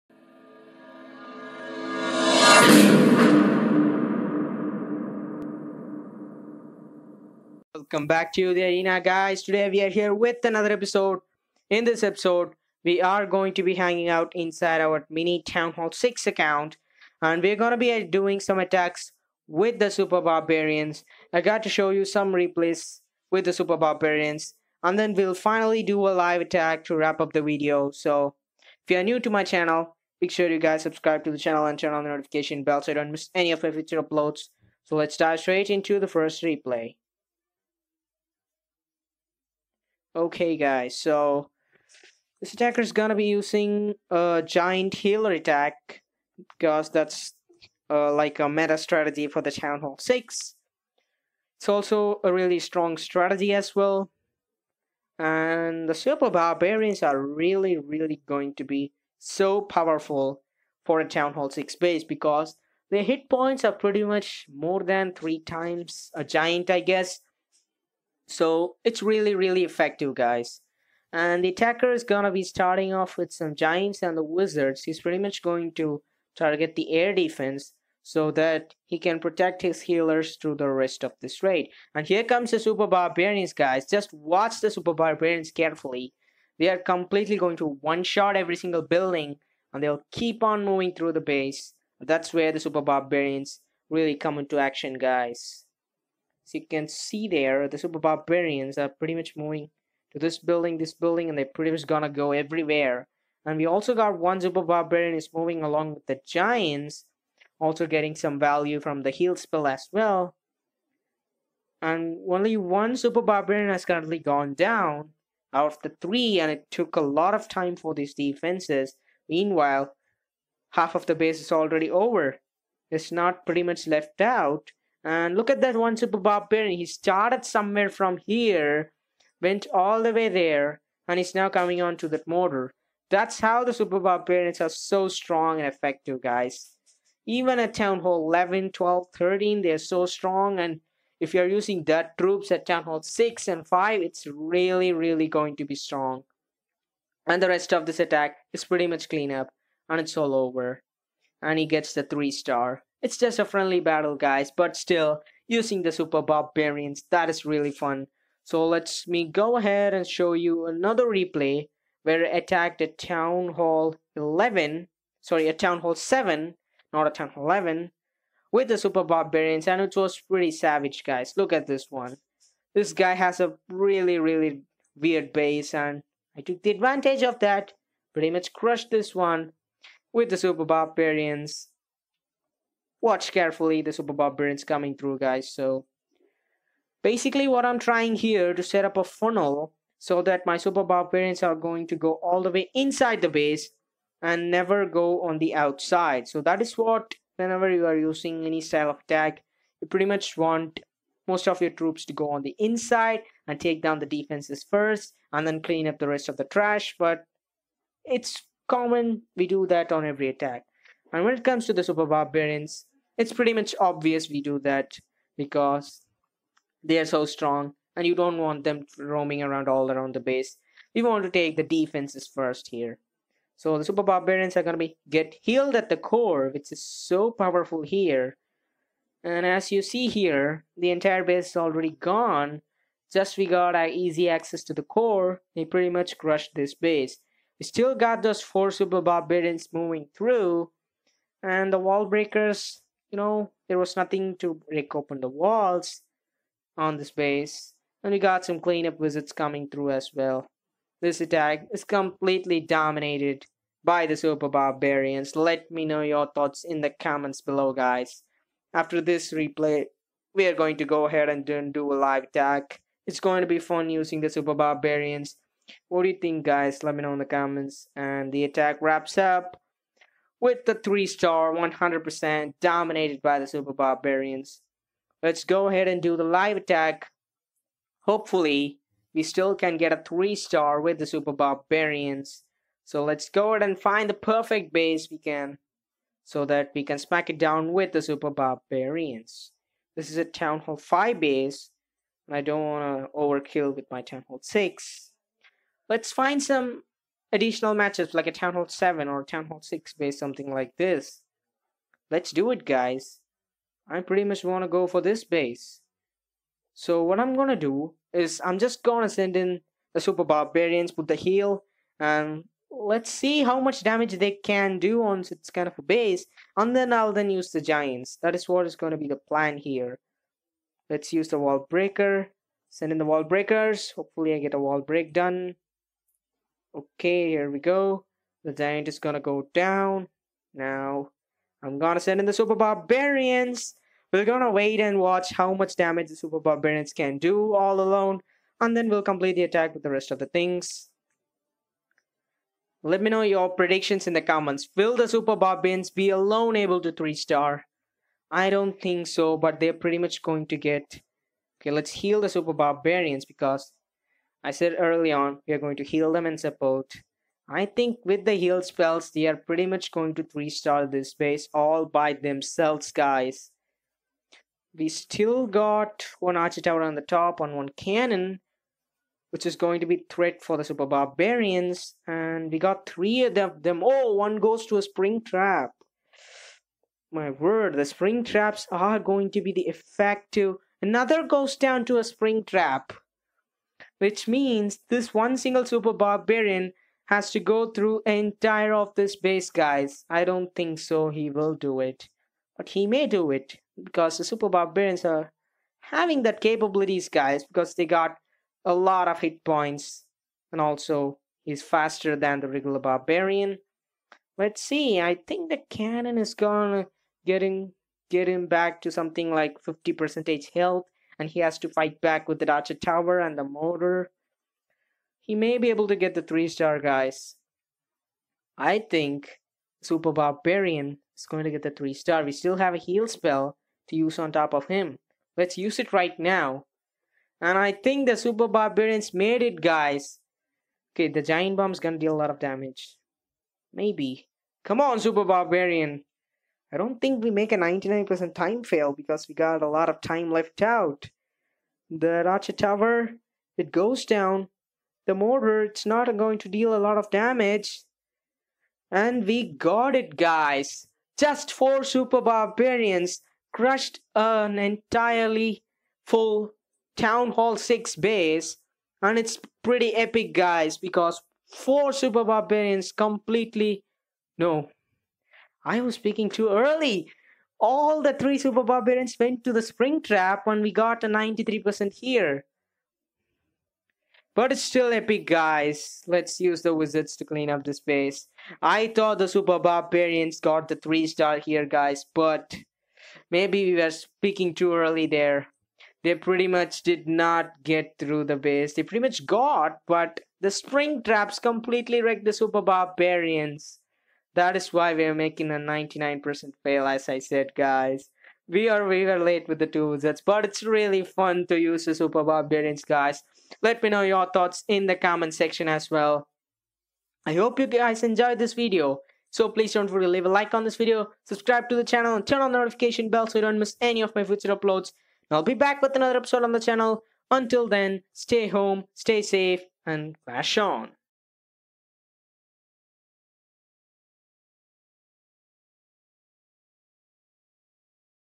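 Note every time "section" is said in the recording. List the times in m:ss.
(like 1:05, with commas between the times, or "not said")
8:25.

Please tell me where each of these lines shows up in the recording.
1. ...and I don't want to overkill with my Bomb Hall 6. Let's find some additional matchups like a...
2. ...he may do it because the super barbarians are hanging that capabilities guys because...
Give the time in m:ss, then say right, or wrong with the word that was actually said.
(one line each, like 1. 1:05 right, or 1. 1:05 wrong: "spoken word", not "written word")
1. 4:52 wrong: "Town", not "Bomb"
2. 6:32 wrong: "having", not "hanging".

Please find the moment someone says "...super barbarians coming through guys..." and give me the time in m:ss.
3:03.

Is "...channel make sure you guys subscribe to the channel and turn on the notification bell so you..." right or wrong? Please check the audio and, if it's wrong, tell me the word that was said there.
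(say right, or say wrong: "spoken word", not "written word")
right.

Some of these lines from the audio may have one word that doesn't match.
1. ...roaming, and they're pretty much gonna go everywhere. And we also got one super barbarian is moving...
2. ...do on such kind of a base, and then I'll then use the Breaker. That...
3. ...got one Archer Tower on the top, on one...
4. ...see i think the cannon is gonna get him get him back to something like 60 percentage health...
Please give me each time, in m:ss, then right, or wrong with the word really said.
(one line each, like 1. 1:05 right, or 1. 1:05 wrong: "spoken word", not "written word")
1. 1:40 wrong: "building", not "roaming"
2. 5:14 wrong: "Giants", not "Breaker"
3. 6:05 right
4. 6:44 wrong: "50", not "60".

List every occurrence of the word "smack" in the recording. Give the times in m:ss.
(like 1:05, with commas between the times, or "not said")
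4:46.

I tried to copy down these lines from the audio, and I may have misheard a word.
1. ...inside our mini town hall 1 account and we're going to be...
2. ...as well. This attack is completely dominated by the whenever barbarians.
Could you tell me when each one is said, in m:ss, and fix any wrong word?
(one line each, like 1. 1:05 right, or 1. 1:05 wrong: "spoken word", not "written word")
1. 0:14 wrong: "6", not "1"
2. 4:09 wrong: "super", not "whenever".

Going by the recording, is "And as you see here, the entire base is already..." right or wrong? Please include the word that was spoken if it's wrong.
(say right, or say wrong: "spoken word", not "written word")
right.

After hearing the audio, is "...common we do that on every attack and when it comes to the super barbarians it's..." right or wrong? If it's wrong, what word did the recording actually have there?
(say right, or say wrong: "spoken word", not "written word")
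right.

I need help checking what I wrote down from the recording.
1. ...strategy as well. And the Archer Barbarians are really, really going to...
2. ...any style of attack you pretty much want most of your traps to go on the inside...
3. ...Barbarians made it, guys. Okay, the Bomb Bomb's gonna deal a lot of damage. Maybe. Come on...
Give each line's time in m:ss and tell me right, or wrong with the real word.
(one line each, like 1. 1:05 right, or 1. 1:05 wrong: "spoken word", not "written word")
1. 0:52 wrong: "Super", not "Archer"
2. 3:18 wrong: "troops", not "traps"
3. 7:08 wrong: "Giant", not "Bomb".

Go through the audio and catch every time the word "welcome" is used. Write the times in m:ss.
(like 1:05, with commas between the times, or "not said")
0:07.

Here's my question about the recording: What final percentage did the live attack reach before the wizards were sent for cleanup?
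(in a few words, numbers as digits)
93%.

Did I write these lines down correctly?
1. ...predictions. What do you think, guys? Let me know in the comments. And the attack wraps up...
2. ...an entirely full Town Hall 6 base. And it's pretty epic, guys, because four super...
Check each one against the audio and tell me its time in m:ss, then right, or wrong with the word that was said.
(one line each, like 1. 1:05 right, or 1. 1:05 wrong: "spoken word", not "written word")
1. 4:24 wrong: "barbarians", not "predictions"
2. 7:34 right.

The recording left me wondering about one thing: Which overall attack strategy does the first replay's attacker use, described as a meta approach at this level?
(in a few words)
Giant healer attack.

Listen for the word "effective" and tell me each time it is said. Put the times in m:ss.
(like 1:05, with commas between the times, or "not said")
1:09, 2:15, 6:19.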